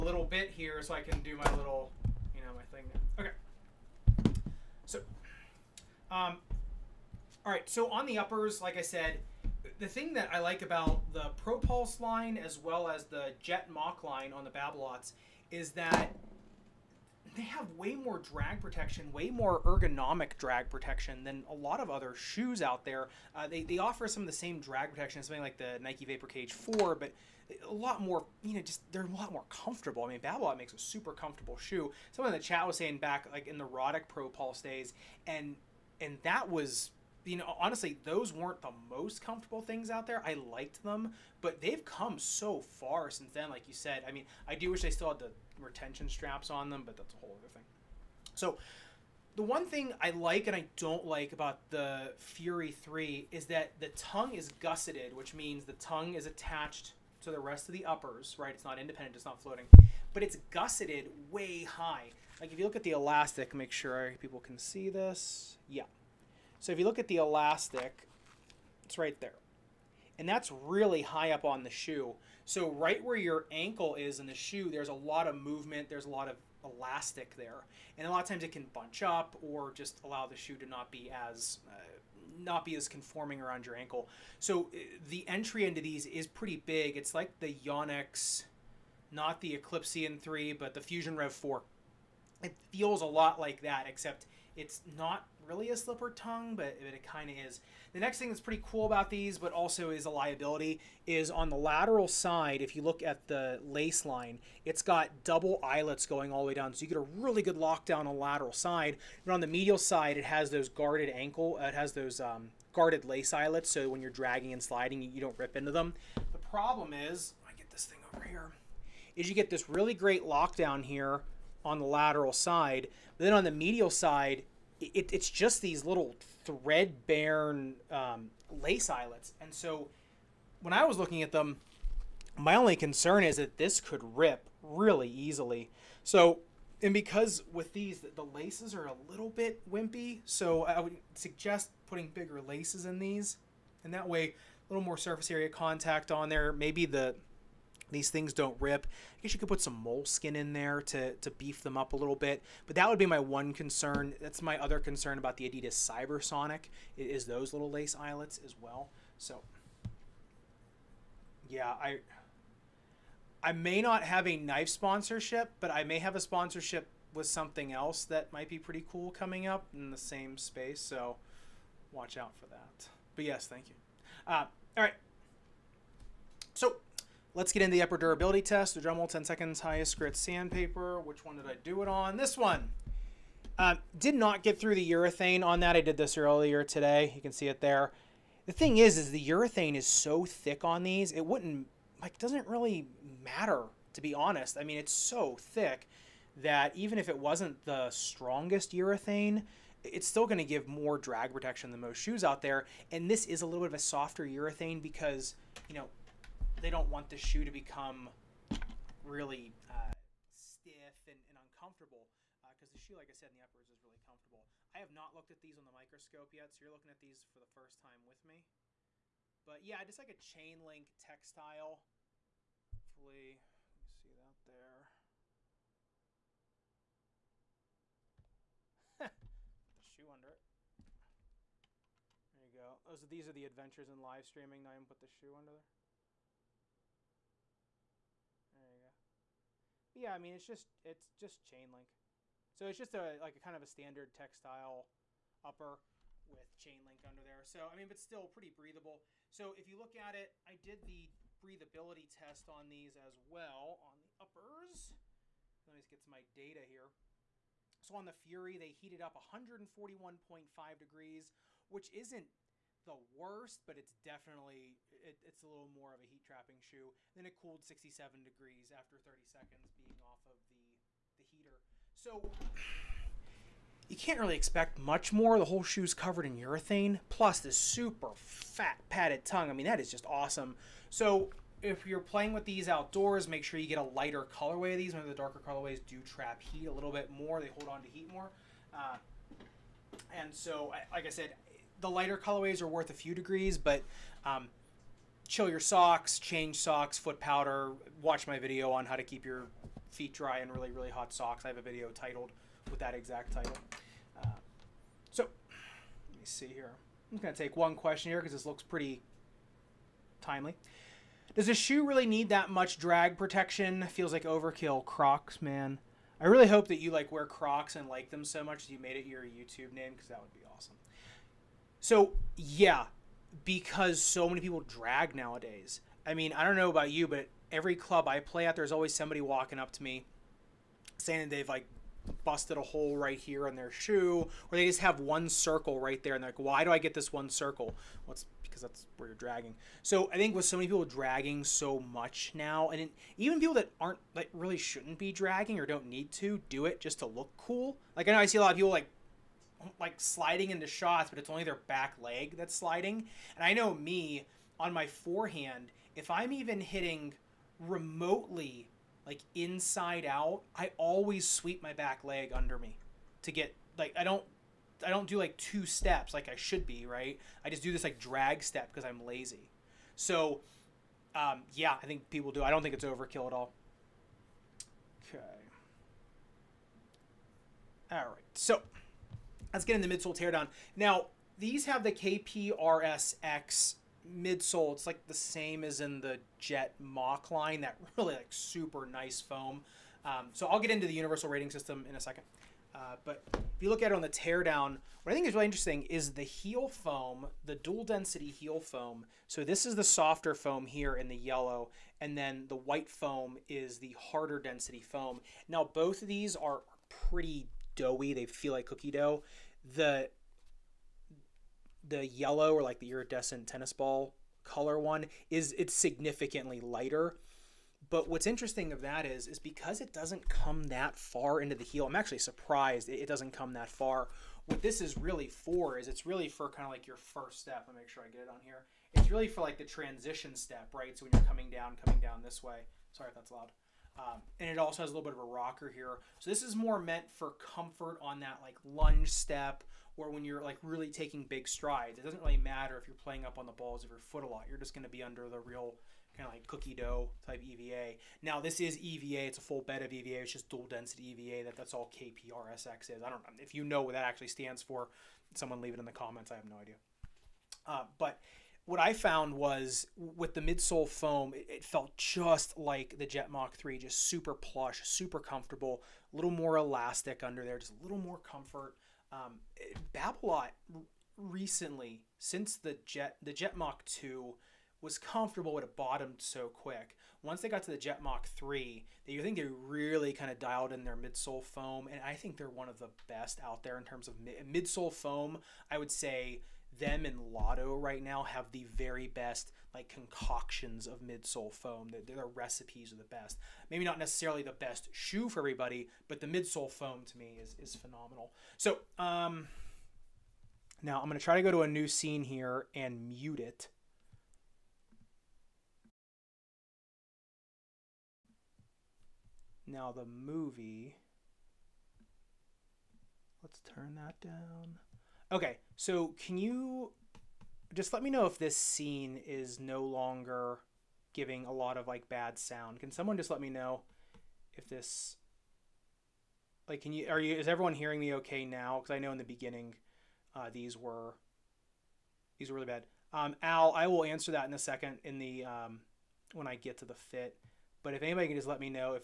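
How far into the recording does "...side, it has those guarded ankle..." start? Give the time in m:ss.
1:49.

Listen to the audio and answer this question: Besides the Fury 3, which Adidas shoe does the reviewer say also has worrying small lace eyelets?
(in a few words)
Adidas Cybersonic.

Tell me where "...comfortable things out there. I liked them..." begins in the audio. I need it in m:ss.
0:39.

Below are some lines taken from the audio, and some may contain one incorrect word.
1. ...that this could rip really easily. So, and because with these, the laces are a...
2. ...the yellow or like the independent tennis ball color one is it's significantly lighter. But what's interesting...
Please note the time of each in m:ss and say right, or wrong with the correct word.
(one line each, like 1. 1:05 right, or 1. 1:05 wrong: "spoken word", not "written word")
1. 2:13 right
2. 6:51 wrong: "iridescent", not "independent".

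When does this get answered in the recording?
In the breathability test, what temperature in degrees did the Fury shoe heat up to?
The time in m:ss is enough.
4:19.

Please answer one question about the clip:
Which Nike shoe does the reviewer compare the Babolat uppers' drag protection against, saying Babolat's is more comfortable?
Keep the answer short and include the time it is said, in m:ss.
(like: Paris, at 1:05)
Nike Vapor Cage 4, at 0:25.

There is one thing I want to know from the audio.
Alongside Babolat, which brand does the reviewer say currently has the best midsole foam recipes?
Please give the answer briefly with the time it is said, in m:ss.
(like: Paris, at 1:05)
Lotto, at 8:07.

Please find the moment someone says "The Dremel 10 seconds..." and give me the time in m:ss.
2:58.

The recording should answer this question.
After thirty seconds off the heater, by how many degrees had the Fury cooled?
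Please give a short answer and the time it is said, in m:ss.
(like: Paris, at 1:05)
67, at 4:27.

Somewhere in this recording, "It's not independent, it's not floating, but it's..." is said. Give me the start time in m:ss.
0:58.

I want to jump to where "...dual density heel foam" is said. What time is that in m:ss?
6:37.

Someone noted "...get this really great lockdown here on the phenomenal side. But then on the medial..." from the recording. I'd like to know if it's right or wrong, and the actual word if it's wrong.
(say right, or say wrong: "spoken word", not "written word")
wrong: "lateral", not "phenomenal".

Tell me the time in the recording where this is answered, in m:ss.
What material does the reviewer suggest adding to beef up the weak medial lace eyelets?
2:29.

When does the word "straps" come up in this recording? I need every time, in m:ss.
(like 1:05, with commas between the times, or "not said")
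0:46.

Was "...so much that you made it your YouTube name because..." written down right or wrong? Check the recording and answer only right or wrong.
right.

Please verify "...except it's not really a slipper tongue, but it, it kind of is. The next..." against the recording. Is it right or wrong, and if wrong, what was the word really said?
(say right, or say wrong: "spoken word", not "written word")
right.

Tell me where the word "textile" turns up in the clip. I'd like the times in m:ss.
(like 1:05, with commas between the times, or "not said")
3:40, 4:04.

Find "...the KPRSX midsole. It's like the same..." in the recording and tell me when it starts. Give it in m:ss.
6:21.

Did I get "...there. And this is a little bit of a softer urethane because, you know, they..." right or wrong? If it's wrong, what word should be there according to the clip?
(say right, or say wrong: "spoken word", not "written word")
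right.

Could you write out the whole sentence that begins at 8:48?
Because I know in the beginning uh, these were these were really bad.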